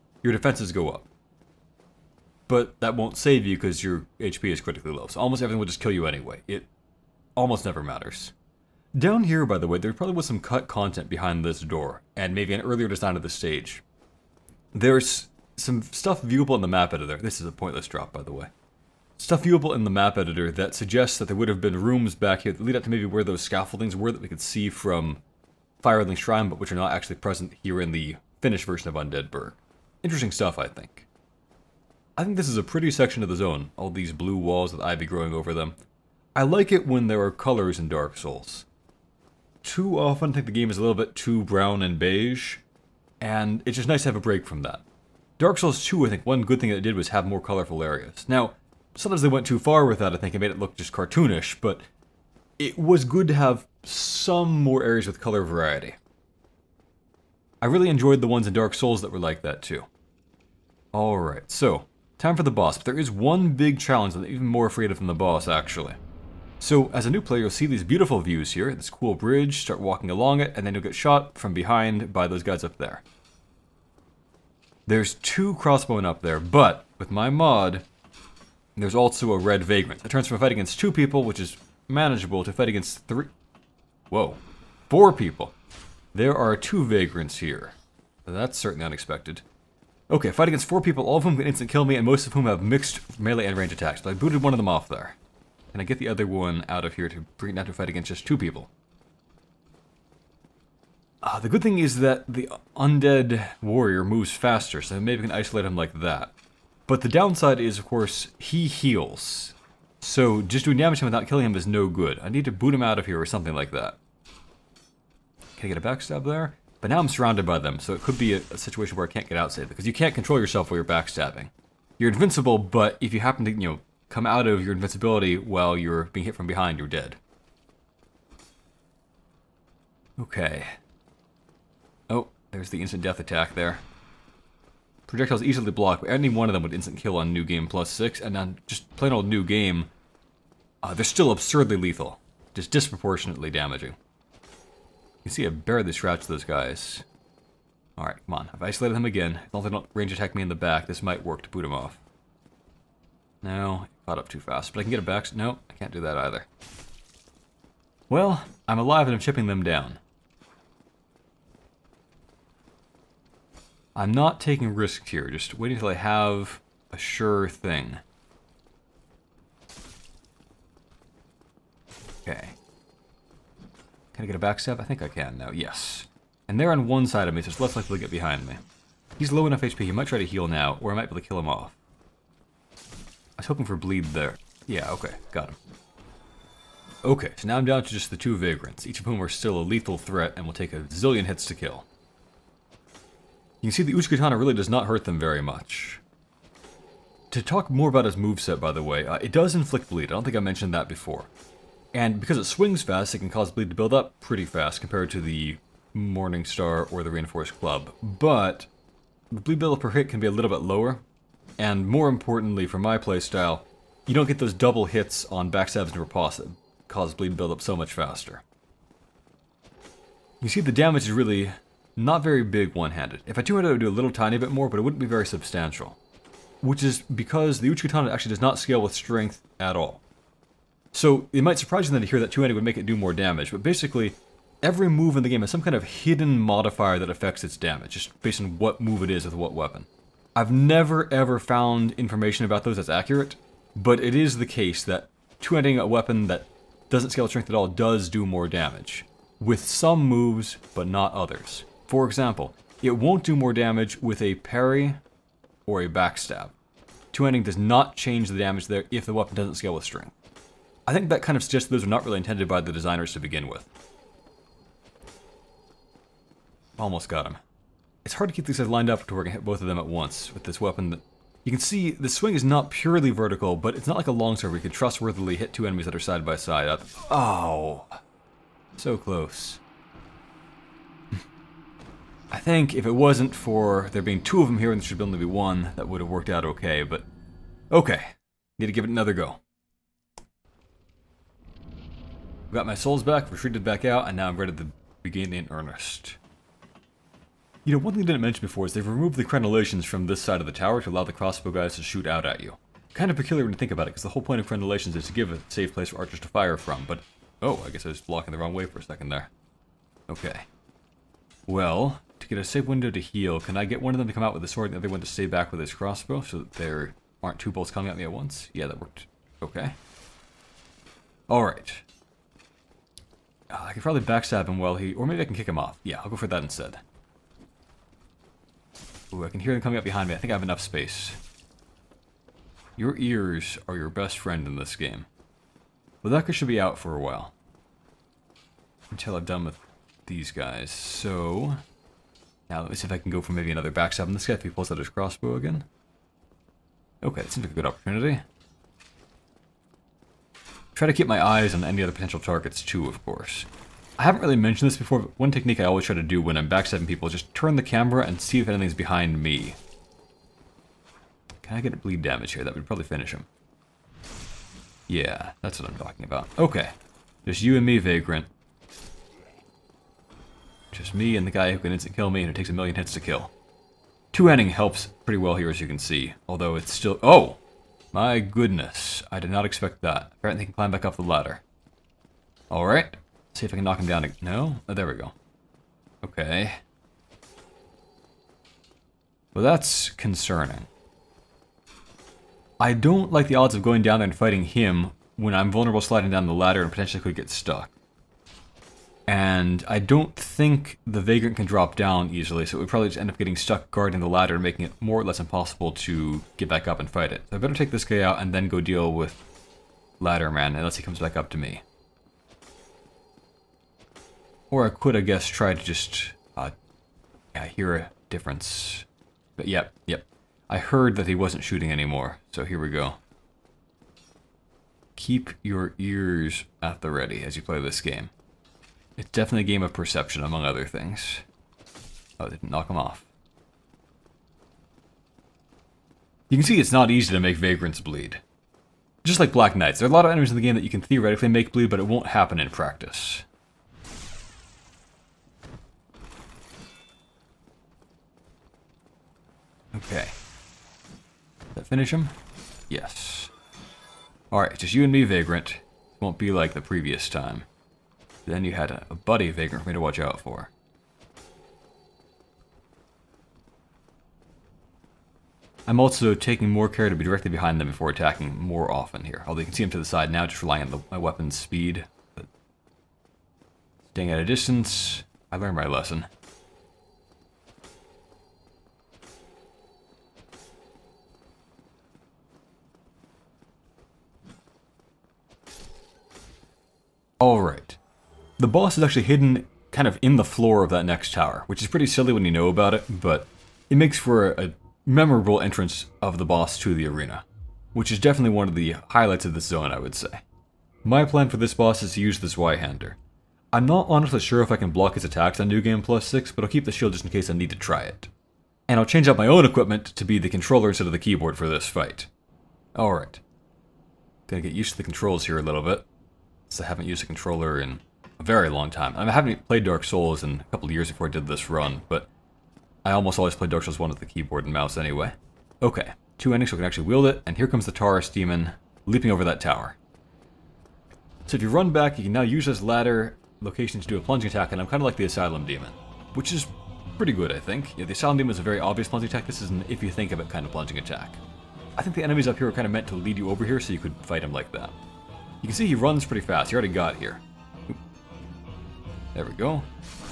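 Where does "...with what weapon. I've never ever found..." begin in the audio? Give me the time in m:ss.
3:59.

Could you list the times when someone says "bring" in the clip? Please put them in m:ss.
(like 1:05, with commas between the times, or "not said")
1:37.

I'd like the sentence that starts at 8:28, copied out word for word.
And I'll change out my own equipment to be the controller instead of the keyboard for this fight.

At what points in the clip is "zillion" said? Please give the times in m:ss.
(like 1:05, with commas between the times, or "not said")
3:10.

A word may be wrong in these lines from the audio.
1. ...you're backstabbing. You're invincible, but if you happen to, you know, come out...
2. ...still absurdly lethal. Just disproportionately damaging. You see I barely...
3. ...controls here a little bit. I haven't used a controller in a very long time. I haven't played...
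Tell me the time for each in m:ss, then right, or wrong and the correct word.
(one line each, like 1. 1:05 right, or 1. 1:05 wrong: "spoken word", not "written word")
1. 2:00 right
2. 2:21 right
3. 8:34 right.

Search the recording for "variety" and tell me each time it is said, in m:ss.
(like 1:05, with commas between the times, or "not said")
0:55.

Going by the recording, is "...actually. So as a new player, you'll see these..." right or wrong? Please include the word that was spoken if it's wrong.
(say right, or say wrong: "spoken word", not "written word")
right.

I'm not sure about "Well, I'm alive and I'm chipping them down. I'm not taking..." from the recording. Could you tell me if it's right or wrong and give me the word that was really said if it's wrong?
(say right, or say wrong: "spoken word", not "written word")
right.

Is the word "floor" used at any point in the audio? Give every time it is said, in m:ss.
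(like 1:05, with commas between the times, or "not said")
8:10.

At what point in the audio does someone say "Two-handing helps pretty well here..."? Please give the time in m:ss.
6:14.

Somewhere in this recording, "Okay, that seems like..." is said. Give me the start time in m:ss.
5:47.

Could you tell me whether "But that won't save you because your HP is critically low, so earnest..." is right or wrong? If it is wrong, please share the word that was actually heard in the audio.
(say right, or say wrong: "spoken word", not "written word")
wrong: "almost", not "earnest".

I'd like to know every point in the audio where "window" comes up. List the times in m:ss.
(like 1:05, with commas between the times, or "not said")
5:12.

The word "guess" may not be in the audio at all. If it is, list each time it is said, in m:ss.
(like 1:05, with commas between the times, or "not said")
5:07, 6:55.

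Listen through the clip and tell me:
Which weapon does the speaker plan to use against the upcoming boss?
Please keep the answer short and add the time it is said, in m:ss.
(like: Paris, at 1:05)
Zweihander, at 8:22.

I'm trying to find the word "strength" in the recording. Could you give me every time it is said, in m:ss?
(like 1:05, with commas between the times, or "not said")
3:48, 4:07, 4:19.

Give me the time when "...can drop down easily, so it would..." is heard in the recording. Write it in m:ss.
6:41.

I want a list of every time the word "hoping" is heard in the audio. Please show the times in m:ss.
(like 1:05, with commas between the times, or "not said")
3:03.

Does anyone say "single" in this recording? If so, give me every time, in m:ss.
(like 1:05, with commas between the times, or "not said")
not said.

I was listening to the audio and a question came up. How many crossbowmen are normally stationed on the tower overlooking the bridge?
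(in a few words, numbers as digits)
2.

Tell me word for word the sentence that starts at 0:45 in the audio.
Dark Souls 2, I think one good thing that it did was have more colorful areas.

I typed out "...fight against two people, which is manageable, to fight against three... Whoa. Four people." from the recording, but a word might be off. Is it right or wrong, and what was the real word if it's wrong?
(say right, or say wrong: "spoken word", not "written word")
right.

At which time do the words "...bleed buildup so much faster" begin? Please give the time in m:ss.
3:37.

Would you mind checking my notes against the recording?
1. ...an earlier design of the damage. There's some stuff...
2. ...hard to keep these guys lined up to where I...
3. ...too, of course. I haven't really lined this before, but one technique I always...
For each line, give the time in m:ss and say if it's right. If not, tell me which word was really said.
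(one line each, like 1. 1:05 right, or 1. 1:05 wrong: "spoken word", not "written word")
1. 0:12 wrong: "stage", not "damage"
2. 4:28 right
3. 5:52 wrong: "mentioned", not "lined".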